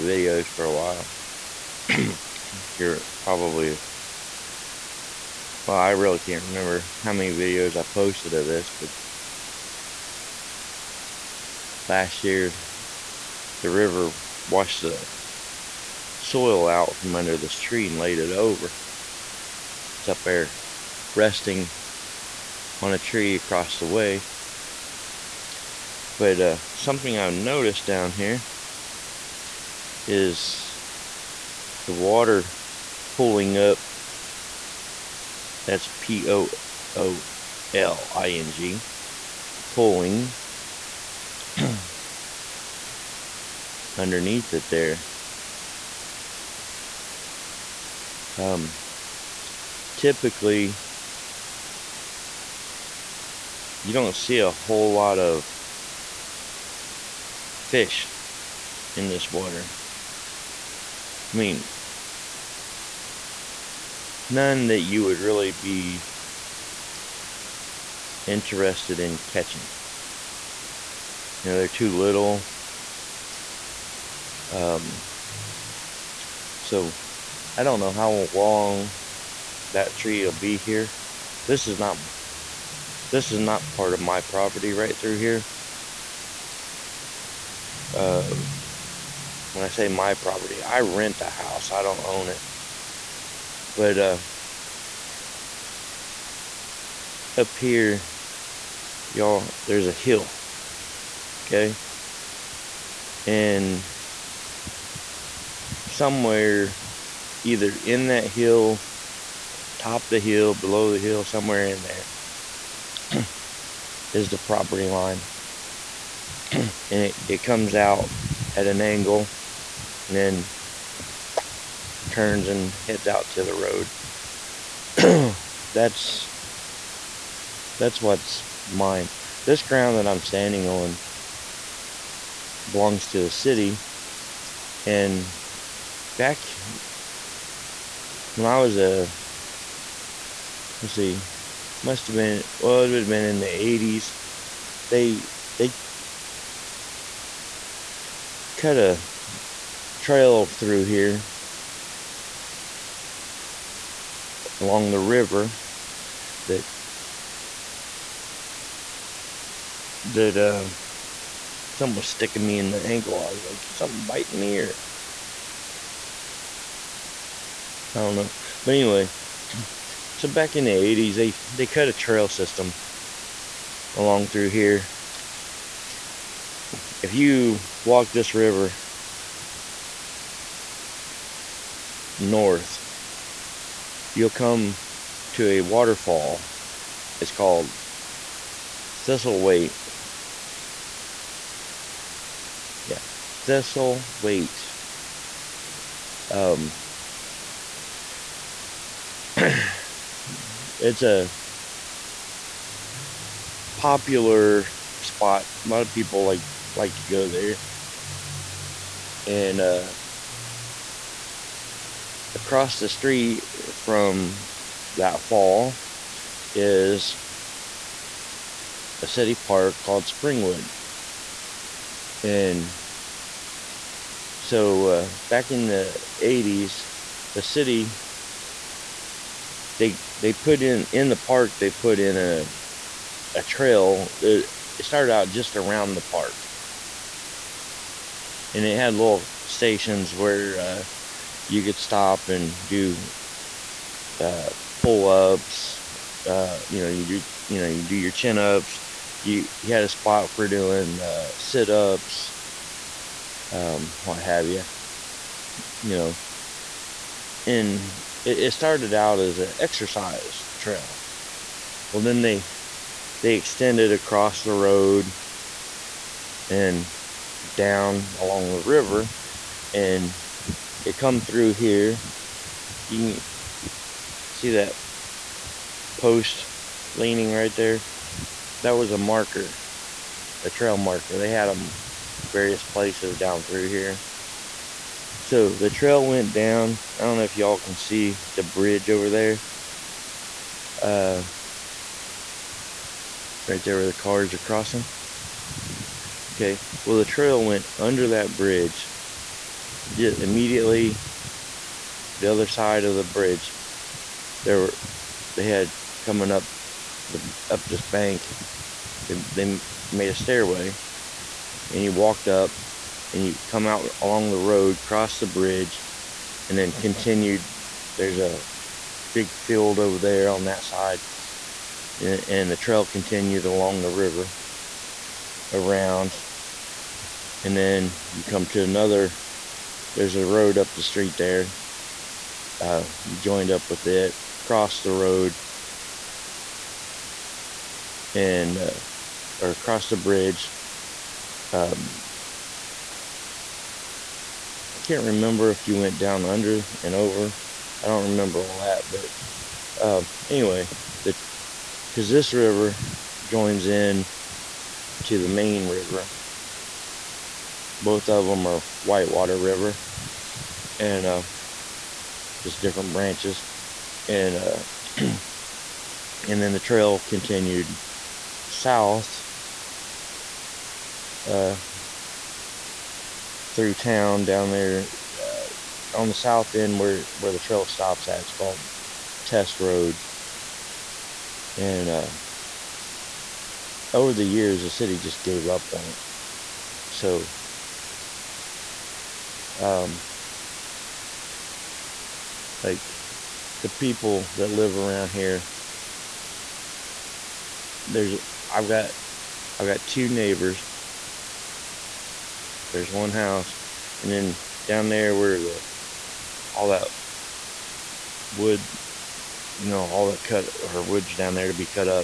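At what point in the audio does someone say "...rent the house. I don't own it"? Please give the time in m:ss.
1:30.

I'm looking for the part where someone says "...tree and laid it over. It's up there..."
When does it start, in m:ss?
0:17.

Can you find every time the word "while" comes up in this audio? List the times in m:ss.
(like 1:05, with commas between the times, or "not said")
0:00.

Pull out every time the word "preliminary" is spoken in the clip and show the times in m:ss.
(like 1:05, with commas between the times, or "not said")
not said.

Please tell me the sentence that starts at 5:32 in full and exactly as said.
Uh, you joined up with it, crossed the road, and uh, or crossed the bridge.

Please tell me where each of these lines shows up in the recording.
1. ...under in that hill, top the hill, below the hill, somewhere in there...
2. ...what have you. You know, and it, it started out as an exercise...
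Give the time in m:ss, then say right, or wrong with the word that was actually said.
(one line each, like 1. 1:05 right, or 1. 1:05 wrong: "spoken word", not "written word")
1. 1:47 wrong: "either", not "under"
2. 4:14 right.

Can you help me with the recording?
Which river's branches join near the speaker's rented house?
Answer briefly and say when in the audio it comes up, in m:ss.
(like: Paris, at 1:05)
Whitewater River, at 5:58.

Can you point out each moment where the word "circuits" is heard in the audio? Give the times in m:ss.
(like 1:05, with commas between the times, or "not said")
not said.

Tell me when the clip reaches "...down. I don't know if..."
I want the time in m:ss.
4:46.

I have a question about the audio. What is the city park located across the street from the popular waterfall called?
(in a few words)
Springwood.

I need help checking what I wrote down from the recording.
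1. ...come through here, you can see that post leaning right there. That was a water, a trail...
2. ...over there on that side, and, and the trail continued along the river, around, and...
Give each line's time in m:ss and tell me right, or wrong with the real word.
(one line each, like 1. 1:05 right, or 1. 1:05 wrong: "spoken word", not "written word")
1. 4:30 wrong: "marker", not "water"
2. 5:19 right.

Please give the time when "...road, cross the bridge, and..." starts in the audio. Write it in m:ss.
5:14.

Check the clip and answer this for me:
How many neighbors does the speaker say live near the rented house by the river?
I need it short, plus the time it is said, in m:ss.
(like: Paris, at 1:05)
2, at 6:39.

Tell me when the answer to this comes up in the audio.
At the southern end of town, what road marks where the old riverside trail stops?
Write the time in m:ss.
6:19.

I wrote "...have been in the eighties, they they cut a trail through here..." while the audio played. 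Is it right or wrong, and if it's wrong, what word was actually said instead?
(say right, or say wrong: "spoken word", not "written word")
right.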